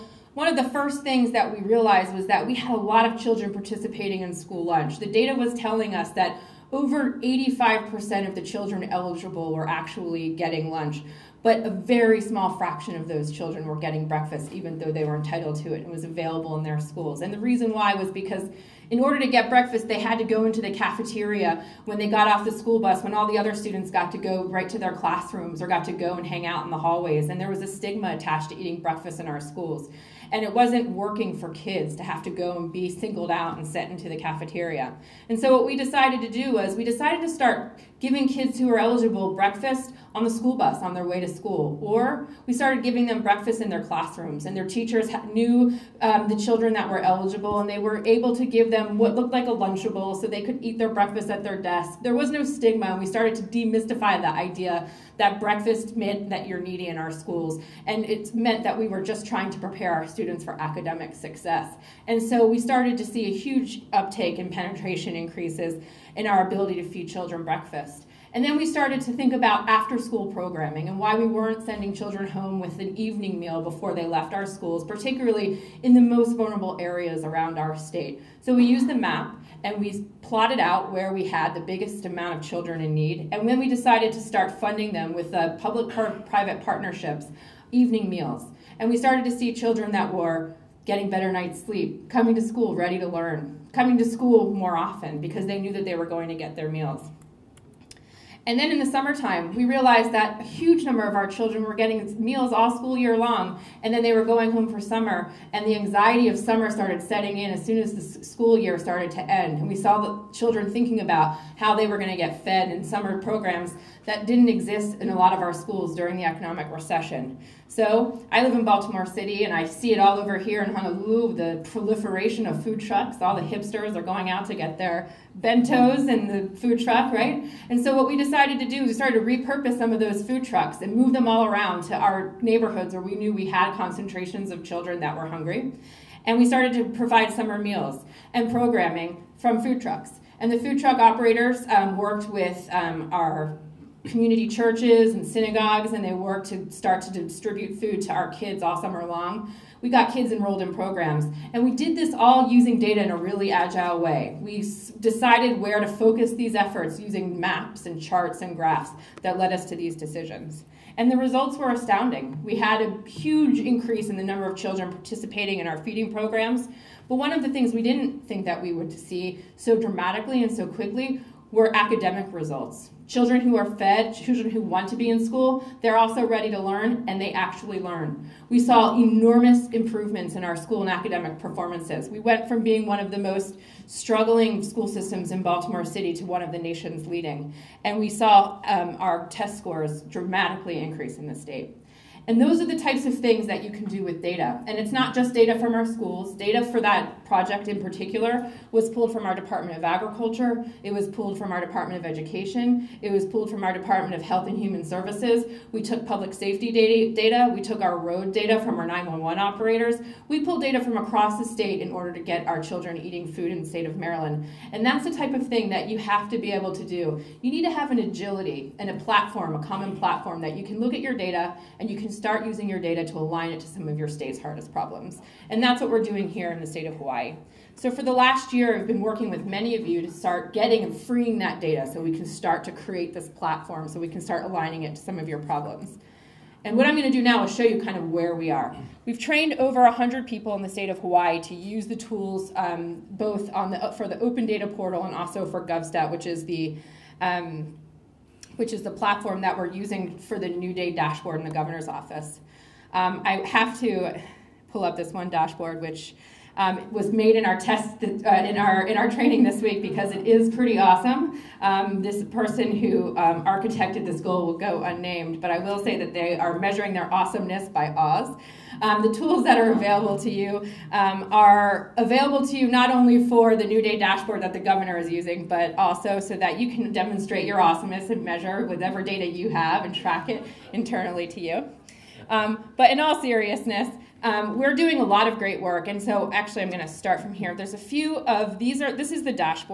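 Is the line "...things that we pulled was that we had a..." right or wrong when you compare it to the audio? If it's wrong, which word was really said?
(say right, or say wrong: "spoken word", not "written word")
wrong: "realized", not "pulled".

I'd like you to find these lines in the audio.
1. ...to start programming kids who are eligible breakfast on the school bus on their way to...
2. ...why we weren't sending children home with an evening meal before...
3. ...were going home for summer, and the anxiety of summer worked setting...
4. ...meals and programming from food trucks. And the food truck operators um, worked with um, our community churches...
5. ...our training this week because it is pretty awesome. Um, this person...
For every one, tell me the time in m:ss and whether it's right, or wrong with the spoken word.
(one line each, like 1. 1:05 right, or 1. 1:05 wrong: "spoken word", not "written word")
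1. 0:37 wrong: "giving", not "programming"
2. 1:10 right
3. 1:44 wrong: "started", not "worked"
4. 2:17 right
5. 4:18 right.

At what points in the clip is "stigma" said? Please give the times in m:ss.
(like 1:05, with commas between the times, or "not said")
0:27, 0:52.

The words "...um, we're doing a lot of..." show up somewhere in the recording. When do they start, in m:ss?
4:44.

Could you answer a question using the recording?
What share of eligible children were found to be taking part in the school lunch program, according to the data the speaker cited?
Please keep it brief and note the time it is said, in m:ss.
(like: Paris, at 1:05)
over 85%, at 0:06.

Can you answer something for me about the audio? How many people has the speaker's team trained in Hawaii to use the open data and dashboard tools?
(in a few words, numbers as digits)
over 100.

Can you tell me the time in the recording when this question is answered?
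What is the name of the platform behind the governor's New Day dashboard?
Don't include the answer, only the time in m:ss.
4:05.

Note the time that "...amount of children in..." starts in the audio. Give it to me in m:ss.
1:22.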